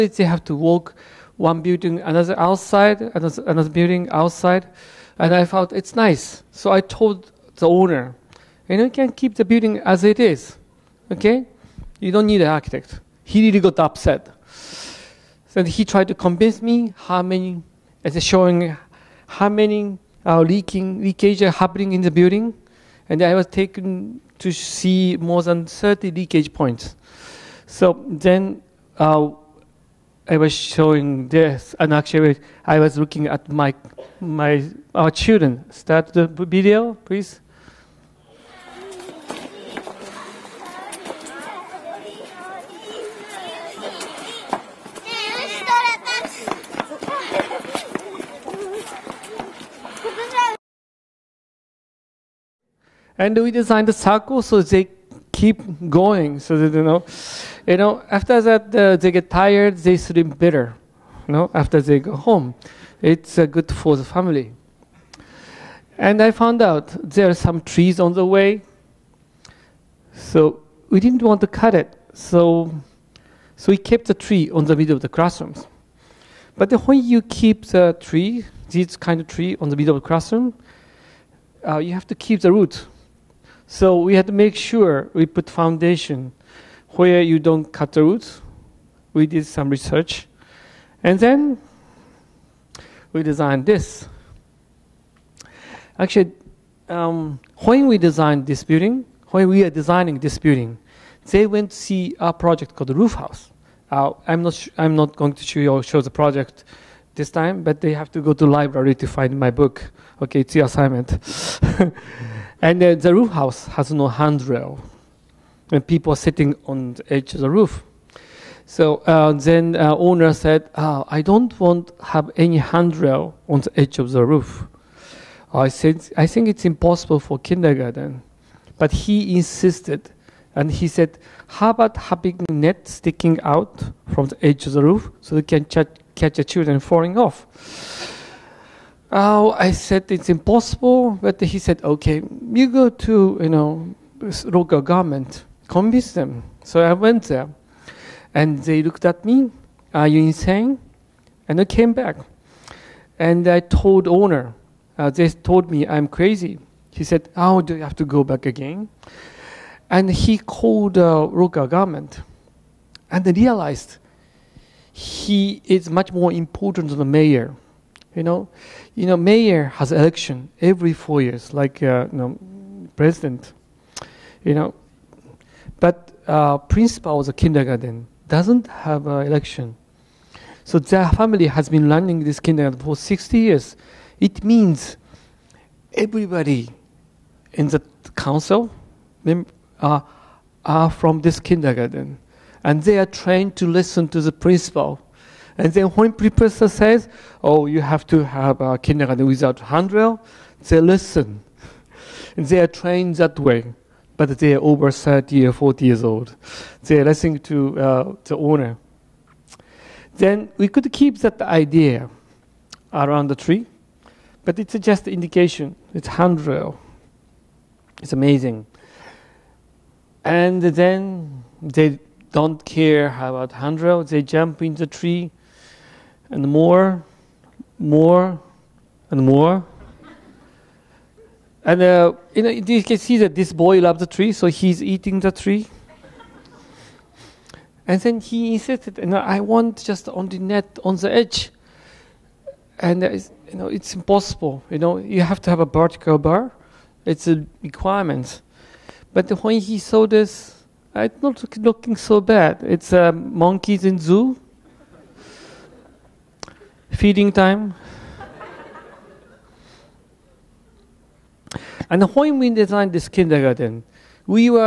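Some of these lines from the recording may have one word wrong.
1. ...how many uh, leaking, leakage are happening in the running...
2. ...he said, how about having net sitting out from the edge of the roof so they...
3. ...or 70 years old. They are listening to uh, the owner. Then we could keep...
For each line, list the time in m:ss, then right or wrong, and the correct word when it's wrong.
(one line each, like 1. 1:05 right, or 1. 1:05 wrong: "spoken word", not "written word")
1. 0:19 wrong: "building", not "running"
2. 2:10 wrong: "sticking", not "sitting"
3. 3:25 wrong: "40", not "70".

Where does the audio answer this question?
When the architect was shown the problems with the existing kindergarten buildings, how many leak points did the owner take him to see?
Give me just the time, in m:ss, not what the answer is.
0:25.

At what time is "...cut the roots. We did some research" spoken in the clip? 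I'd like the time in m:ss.
1:27.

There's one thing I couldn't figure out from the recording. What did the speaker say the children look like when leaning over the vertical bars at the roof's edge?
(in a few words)
monkeys in zoo feeding time.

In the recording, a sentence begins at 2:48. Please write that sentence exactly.
You know, mayor has election every four years, like uh, you know, president.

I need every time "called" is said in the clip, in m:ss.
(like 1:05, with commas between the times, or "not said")
1:42, 2:40.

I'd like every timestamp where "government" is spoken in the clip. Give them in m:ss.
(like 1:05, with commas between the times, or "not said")
2:24, 2:41.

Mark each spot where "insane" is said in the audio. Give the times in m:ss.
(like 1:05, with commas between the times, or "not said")
2:30.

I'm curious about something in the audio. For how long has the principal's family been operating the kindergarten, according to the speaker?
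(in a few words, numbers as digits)
60 years.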